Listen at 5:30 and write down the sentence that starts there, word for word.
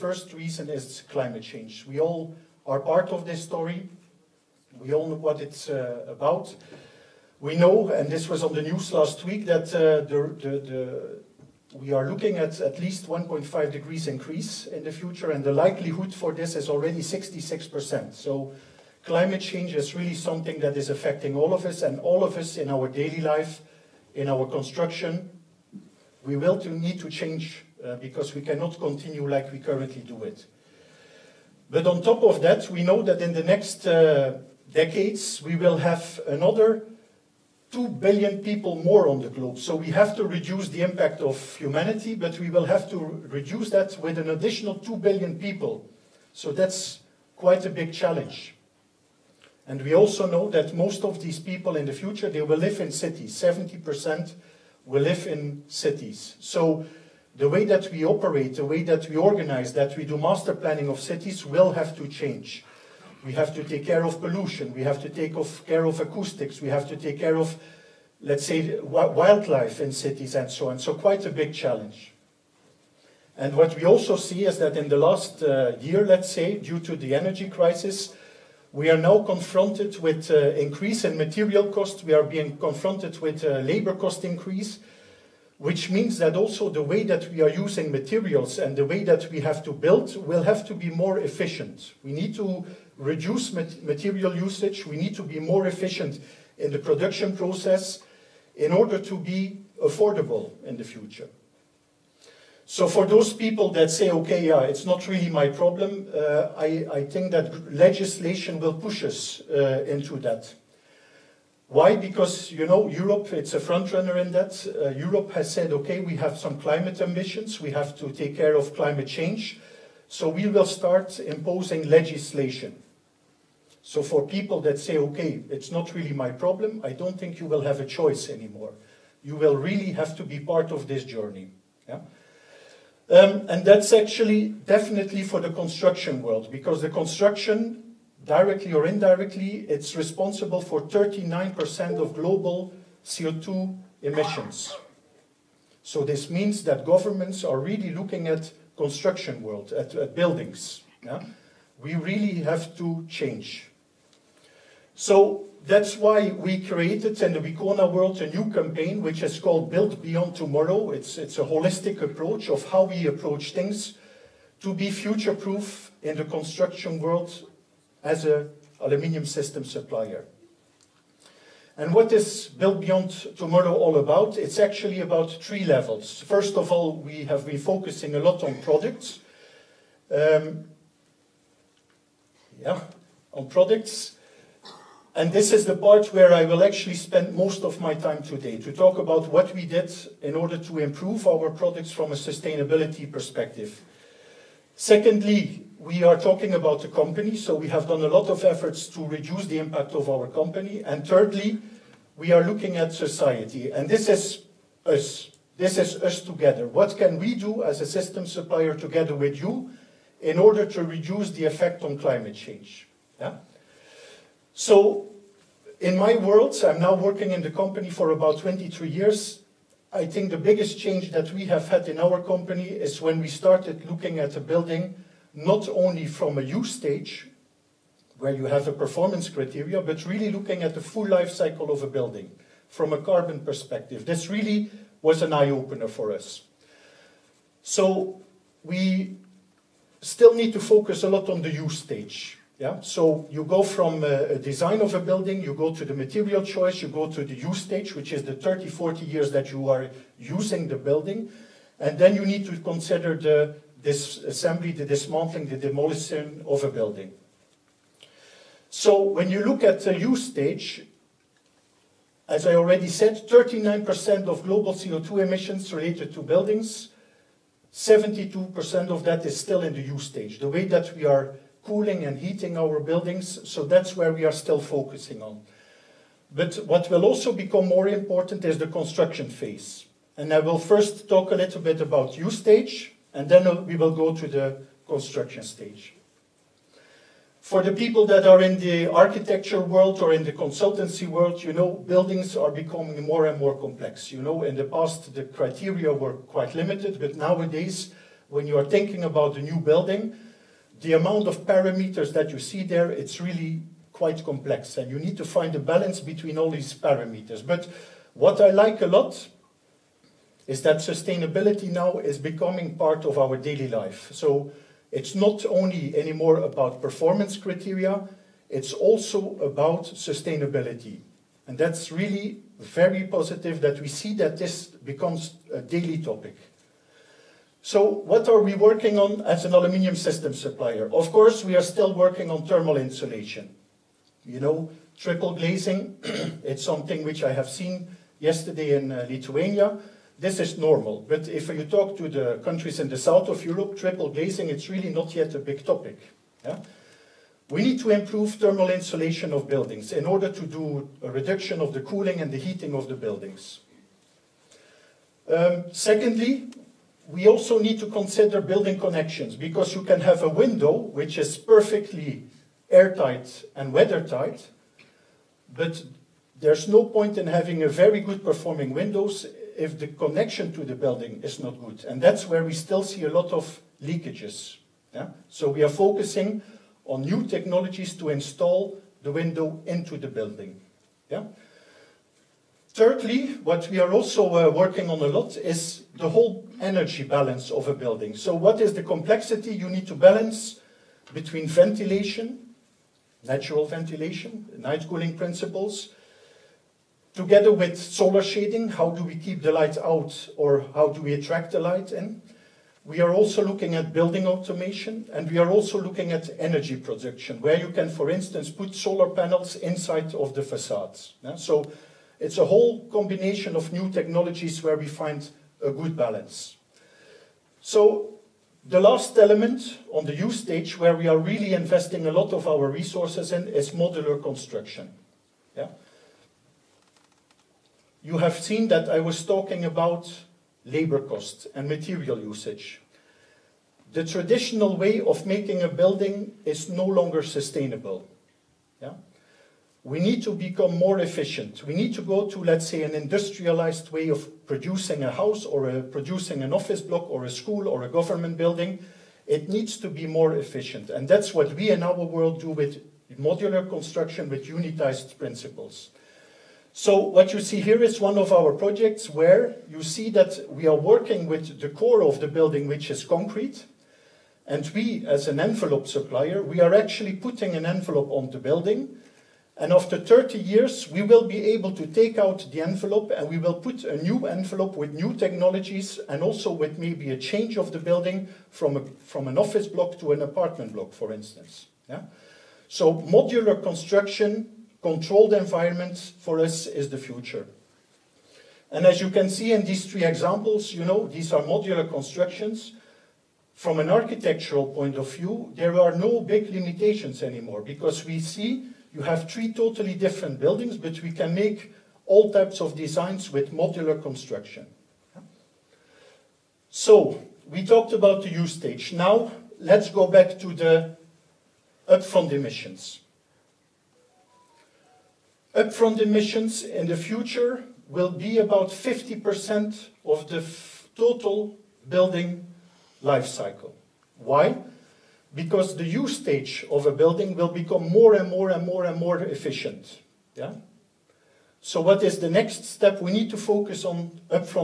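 Of course, we are still working on thermal insulation.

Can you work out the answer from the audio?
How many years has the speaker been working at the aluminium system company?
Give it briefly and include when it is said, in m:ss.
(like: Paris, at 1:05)
23 years, at 3:38.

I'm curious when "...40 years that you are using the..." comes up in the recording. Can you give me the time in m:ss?
4:08.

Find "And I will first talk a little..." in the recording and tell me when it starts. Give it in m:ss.
4:40.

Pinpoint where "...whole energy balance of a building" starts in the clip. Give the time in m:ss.
6:26.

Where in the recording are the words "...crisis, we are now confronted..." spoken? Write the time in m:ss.
1:17.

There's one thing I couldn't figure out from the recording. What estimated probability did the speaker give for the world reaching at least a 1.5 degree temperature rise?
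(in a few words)
66%.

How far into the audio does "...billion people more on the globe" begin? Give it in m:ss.
0:37.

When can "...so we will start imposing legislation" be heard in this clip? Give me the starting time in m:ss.
2:00.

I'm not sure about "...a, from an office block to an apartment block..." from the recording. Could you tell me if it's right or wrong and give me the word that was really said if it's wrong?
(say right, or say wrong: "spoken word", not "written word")
right.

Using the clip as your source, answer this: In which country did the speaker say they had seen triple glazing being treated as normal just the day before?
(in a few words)
Lithuania.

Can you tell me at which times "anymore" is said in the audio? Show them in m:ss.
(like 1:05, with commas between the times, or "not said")
2:08, 5:15, 8:17.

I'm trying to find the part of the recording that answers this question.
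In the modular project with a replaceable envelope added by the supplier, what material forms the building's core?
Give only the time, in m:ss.
7:43.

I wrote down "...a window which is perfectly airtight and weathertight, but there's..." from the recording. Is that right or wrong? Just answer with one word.
right.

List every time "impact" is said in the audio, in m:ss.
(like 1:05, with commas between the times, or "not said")
0:40, 3:19.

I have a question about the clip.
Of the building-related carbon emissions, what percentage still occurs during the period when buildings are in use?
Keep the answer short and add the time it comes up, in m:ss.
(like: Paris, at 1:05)
72%, at 4:27.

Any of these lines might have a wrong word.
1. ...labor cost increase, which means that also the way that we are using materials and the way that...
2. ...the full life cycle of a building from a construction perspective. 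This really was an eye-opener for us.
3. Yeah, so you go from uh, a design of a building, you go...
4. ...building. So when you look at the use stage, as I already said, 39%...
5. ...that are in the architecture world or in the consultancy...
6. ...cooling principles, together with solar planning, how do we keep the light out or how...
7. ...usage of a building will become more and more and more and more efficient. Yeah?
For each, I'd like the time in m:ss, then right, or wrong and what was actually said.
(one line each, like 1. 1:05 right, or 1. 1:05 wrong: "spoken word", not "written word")
1. 1:23 right
2. 3:50 wrong: "carbon", not "construction"
3. 4:02 right
4. 4:16 right
5. 4:48 right
6. 6:34 wrong: "shading", not "planning"
7. 8:46 wrong: "stage", not "usage".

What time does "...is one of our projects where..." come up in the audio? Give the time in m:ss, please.
7:37.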